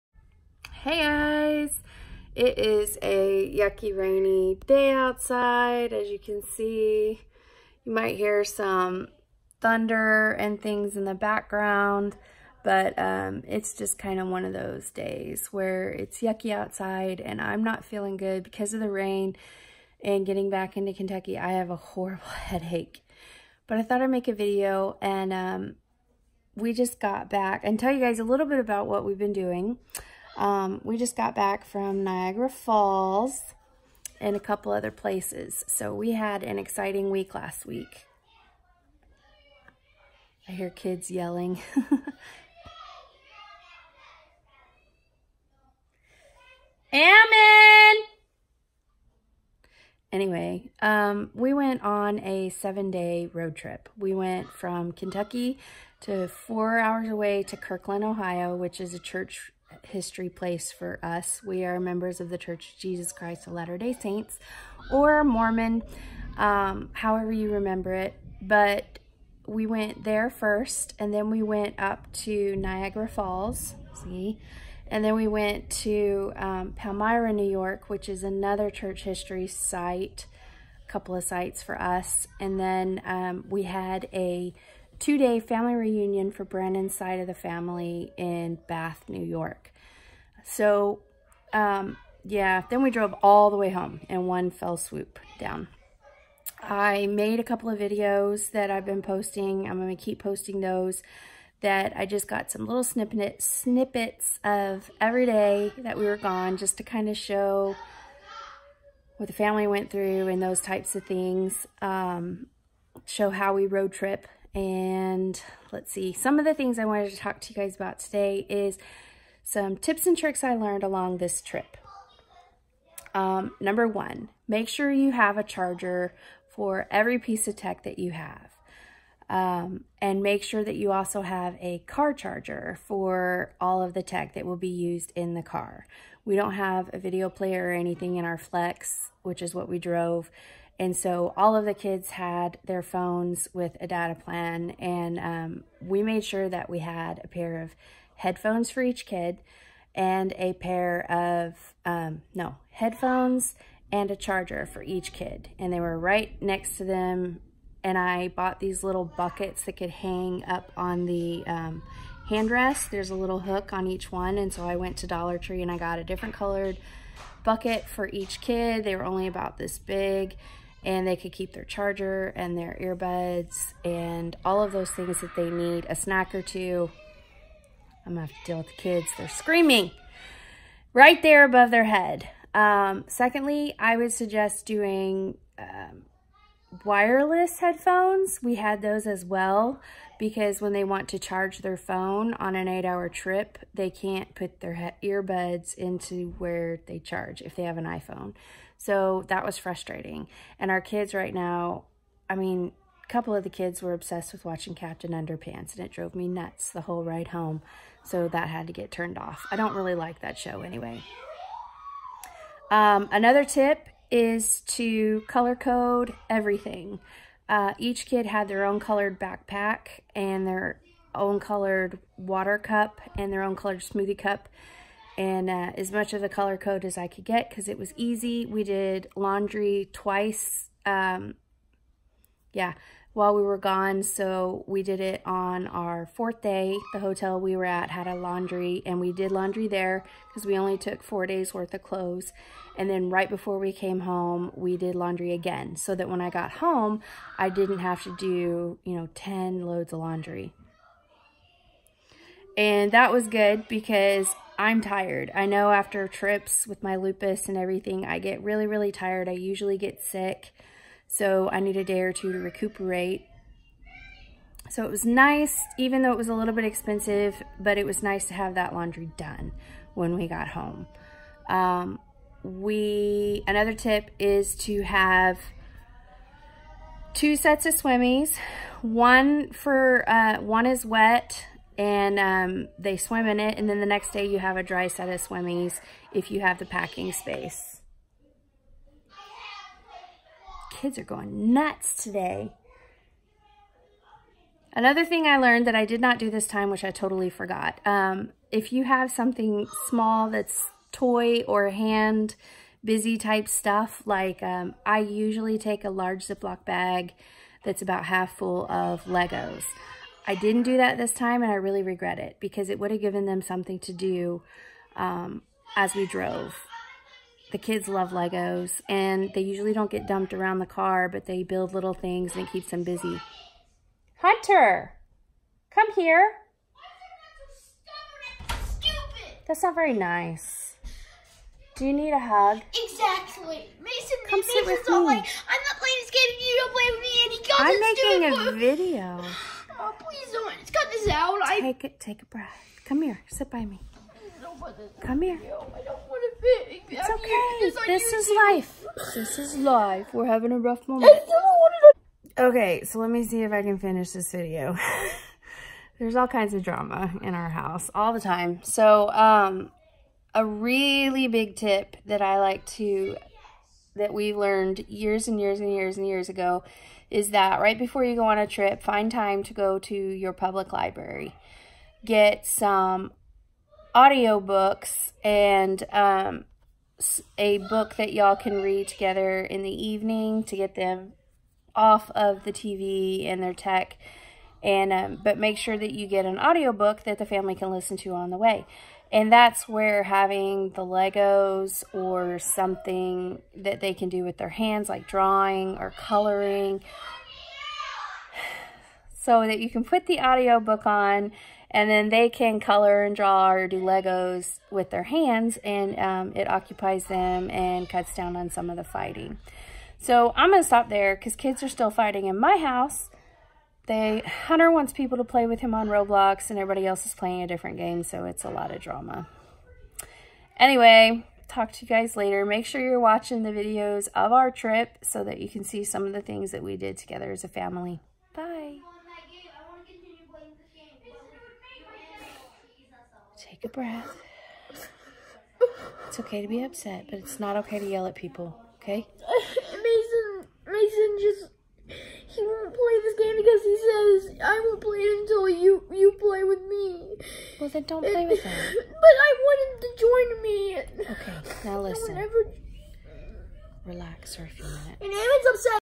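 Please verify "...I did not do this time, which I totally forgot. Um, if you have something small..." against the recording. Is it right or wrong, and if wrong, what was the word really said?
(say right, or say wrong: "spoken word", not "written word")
right.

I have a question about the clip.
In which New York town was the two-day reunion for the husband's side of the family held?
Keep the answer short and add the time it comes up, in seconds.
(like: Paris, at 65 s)
Bath, New York, at 88 s.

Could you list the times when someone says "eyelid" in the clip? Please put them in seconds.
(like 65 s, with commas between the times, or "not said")
not said.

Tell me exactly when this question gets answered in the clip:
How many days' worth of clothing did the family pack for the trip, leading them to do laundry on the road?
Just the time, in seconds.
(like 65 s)
241 s.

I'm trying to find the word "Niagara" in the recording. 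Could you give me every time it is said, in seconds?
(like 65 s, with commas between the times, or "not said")
32 s, 72 s.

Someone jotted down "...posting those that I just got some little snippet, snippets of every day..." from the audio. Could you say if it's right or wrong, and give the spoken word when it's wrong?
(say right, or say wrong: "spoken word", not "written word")
right.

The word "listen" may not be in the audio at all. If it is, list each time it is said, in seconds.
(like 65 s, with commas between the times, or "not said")
387 s, 451 s.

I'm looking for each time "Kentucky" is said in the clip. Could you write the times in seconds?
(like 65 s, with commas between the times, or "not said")
20 s, 54 s.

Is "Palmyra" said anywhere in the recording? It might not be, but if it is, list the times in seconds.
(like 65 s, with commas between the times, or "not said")
76 s.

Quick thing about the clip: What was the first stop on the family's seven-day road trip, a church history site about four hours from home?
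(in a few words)
Kirtland, Ohio.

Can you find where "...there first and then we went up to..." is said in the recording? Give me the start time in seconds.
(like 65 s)
70 s.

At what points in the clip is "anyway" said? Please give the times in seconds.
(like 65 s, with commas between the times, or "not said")
50 s, 210 s, 420 s.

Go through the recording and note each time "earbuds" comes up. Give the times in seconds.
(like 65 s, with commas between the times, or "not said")
172 s, 195 s.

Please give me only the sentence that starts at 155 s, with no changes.
And they were right next to them.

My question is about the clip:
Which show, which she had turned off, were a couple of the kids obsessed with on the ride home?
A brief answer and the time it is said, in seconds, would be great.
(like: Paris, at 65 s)
Captain Underpants, at 204 s.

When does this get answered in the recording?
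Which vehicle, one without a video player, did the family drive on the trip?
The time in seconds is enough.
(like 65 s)
138 s.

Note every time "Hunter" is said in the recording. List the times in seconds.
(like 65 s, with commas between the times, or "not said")
324 s, 413 s.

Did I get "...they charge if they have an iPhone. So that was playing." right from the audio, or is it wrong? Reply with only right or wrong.
wrong.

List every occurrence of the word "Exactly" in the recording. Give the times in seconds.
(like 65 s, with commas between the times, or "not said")
332 s.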